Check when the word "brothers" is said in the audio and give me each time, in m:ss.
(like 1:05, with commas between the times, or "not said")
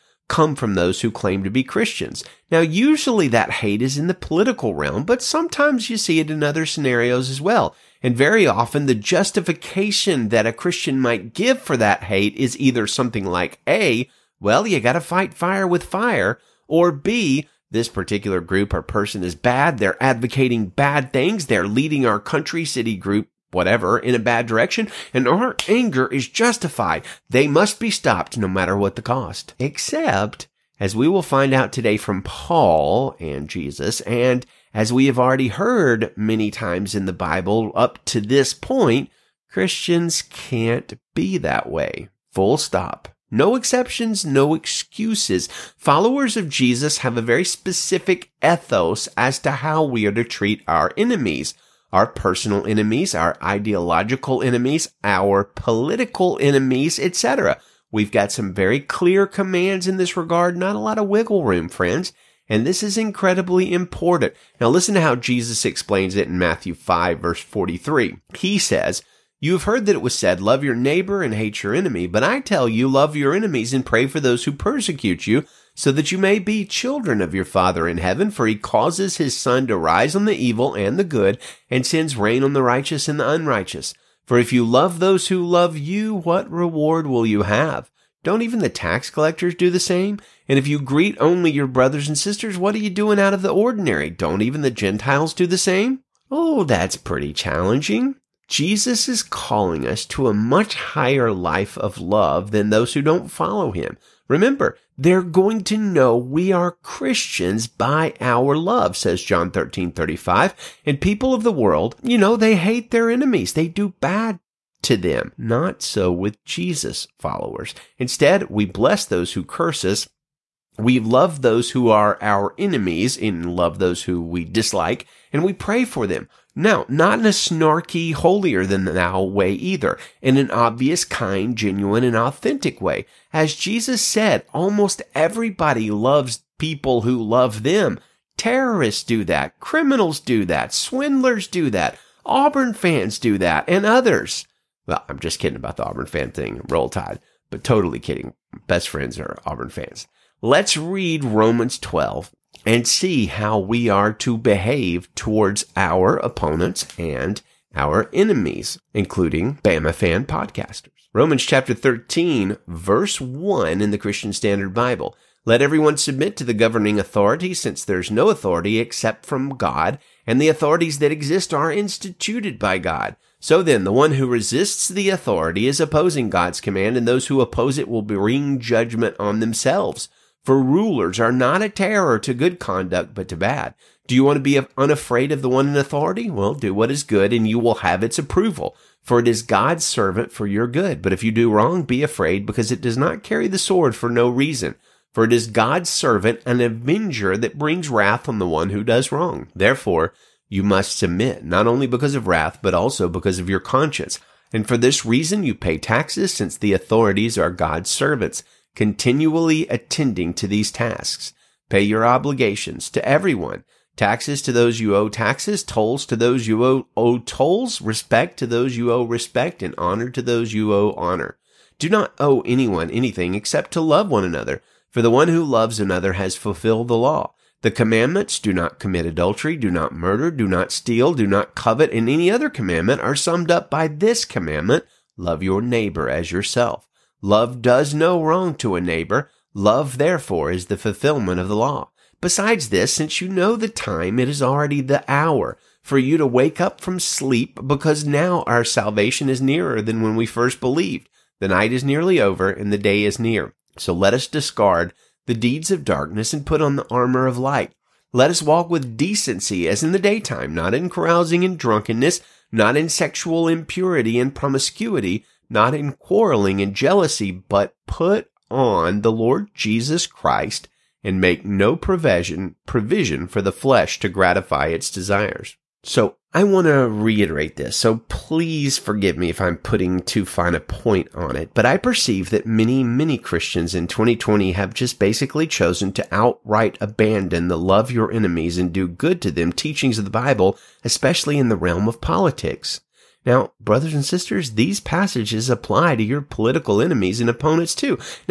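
1:31, 4:53.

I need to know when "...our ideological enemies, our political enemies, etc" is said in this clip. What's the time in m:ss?
0:53.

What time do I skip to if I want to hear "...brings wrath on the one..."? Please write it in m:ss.
3:17.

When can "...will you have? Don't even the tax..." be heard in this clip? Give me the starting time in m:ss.
1:27.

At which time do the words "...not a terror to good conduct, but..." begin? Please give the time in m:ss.
3:01.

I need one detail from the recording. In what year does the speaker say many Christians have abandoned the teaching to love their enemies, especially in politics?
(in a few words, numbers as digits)
2020.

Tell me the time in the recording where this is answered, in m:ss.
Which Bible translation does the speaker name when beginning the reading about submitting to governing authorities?
2:43.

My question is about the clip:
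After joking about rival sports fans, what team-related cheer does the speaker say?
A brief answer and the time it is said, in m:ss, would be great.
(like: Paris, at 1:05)
Roll Tide, at 2:26.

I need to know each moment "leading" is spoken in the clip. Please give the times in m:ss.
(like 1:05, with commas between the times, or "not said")
0:21.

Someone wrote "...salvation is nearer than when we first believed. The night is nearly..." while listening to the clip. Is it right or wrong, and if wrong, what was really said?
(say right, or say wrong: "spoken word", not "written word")
right.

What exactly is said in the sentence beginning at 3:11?
But if you do wrong, be afraid, because it does not carry the sword for no reason.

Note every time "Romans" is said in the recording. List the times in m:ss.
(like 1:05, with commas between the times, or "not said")
2:31, 2:41.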